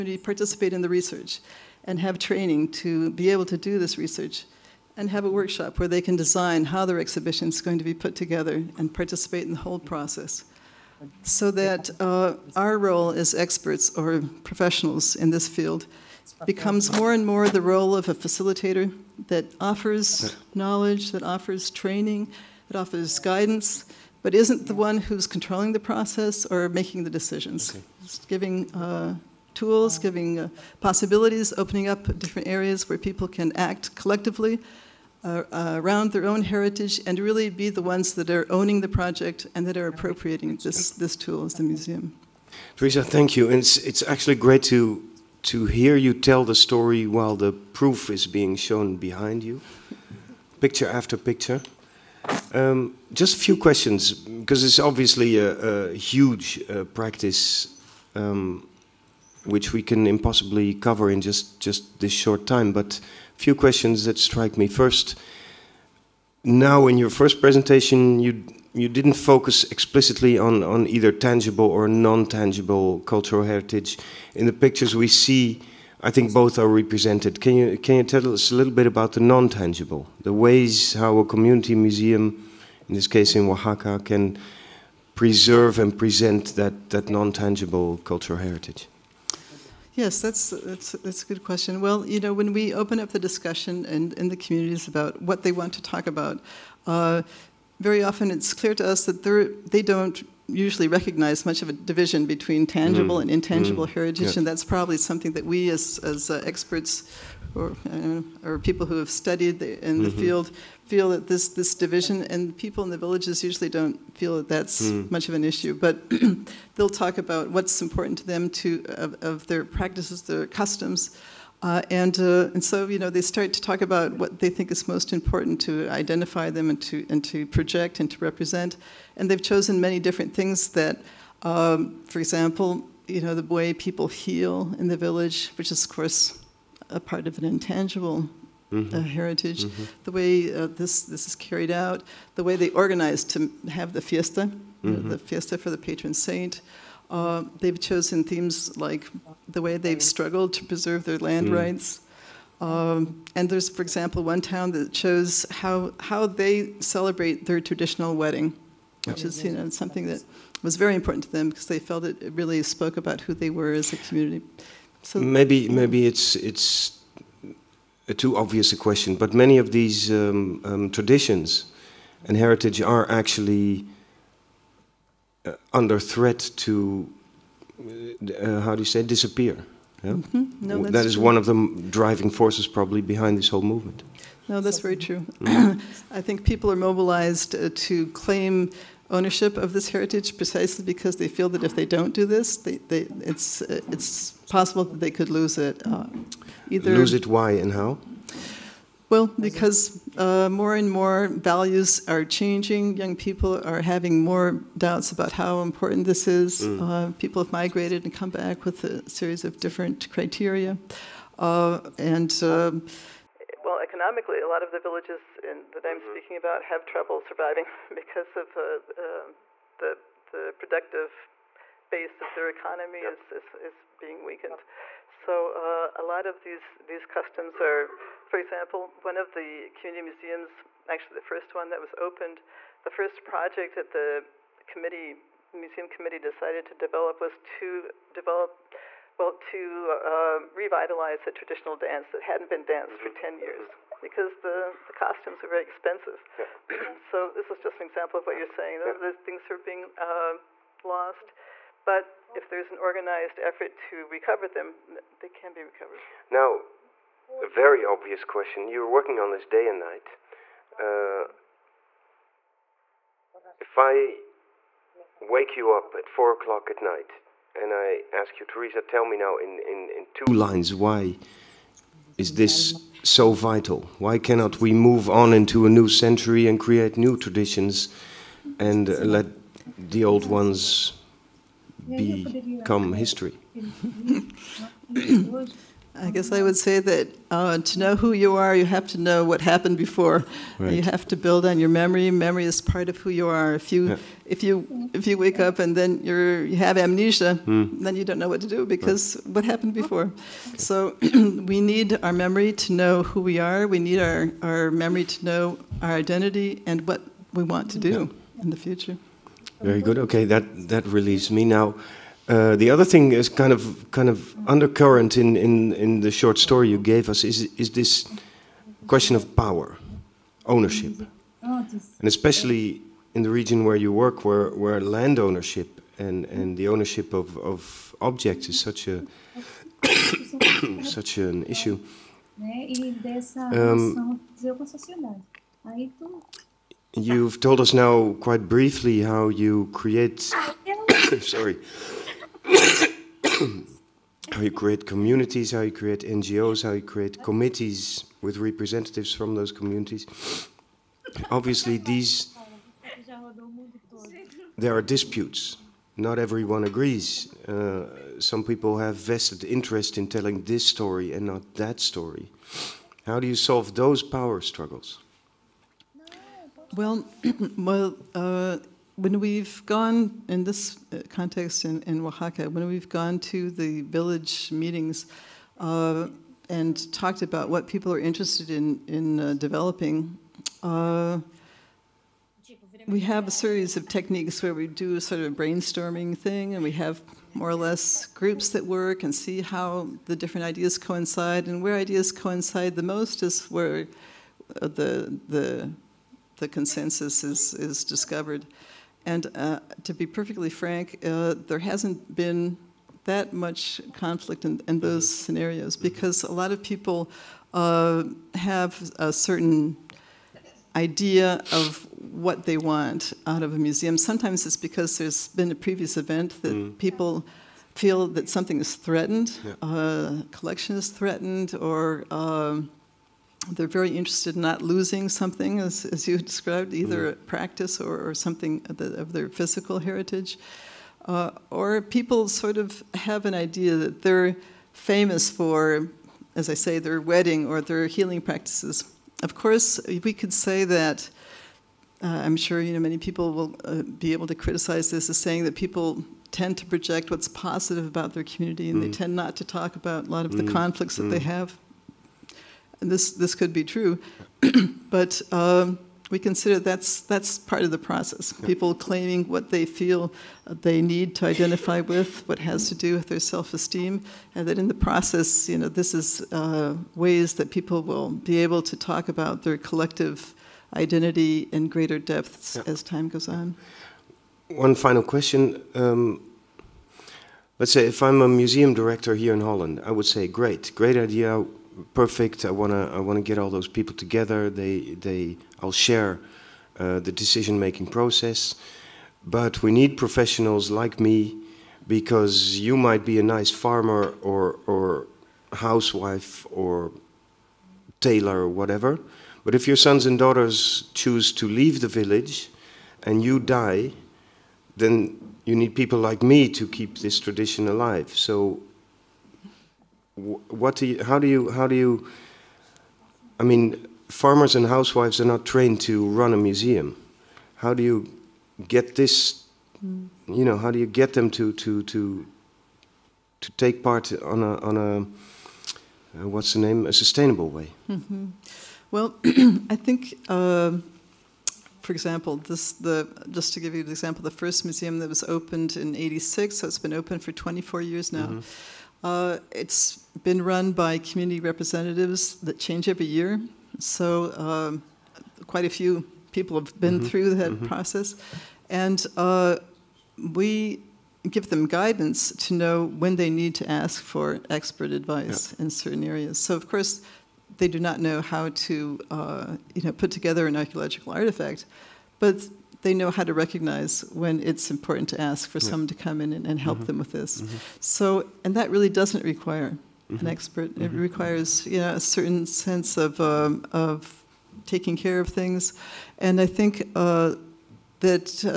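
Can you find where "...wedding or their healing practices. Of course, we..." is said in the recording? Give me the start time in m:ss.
7:17.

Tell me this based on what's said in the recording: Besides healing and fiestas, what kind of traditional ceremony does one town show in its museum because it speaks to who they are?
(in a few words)
traditional wedding.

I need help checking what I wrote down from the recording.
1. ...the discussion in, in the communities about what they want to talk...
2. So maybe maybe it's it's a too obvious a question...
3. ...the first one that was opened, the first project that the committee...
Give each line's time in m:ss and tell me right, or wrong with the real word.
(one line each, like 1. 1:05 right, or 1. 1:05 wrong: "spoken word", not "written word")
1. 1:33 right
2. 2:45 right
3. 3:51 right.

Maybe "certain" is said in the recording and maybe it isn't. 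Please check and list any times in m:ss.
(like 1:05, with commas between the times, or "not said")
6:49, 9:15, 9:31.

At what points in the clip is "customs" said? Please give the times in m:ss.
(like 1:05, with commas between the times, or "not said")
2:00, 3:47.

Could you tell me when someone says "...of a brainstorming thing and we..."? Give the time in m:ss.
6:25.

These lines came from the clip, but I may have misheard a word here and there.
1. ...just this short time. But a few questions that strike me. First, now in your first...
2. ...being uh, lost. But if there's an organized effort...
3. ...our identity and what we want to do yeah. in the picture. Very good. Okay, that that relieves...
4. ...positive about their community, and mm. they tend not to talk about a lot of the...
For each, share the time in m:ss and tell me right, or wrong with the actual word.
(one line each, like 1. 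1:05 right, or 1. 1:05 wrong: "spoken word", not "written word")
1. 1:01 right
2. 4:09 right
3. 5:05 wrong: "future", not "picture"
4. 7:27 right.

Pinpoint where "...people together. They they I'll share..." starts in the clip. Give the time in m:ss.
8:03.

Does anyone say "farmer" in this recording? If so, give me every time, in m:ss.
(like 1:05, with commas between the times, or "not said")
8:13, 8:34.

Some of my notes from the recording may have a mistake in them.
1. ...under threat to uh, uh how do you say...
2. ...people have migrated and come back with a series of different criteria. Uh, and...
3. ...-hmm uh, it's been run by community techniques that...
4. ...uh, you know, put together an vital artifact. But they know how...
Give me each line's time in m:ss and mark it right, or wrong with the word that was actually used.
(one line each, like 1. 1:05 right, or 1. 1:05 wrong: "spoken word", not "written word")
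1. 2:55 right
2. 3:27 right
3. 8:58 wrong: "representatives", not "techniques"
4. 9:19 wrong: "archaeological", not "vital".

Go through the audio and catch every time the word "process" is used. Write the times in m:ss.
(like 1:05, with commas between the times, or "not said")
0:09, 0:25, 7:37, 7:44, 8:07, 9:07.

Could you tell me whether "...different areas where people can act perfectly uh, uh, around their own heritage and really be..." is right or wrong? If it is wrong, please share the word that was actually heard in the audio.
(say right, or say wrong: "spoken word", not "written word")
wrong: "collectively", not "perfectly".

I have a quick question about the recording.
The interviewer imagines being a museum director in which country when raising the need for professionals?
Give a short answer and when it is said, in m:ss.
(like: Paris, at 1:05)
Holland, at 7:59.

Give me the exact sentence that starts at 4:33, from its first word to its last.
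Why cannot we move on into a new century and create new traditions and uh, let the old ones become history?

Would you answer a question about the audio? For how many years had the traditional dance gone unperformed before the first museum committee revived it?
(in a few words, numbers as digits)
10.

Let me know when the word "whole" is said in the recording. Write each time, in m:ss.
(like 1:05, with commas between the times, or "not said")
0:09, 3:03.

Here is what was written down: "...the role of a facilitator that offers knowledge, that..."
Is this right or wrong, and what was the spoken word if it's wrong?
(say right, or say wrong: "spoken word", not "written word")
right.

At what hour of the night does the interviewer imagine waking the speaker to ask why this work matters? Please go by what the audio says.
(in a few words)
four o'clock.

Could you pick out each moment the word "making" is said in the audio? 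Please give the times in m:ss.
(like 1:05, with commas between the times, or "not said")
0:26, 8:07.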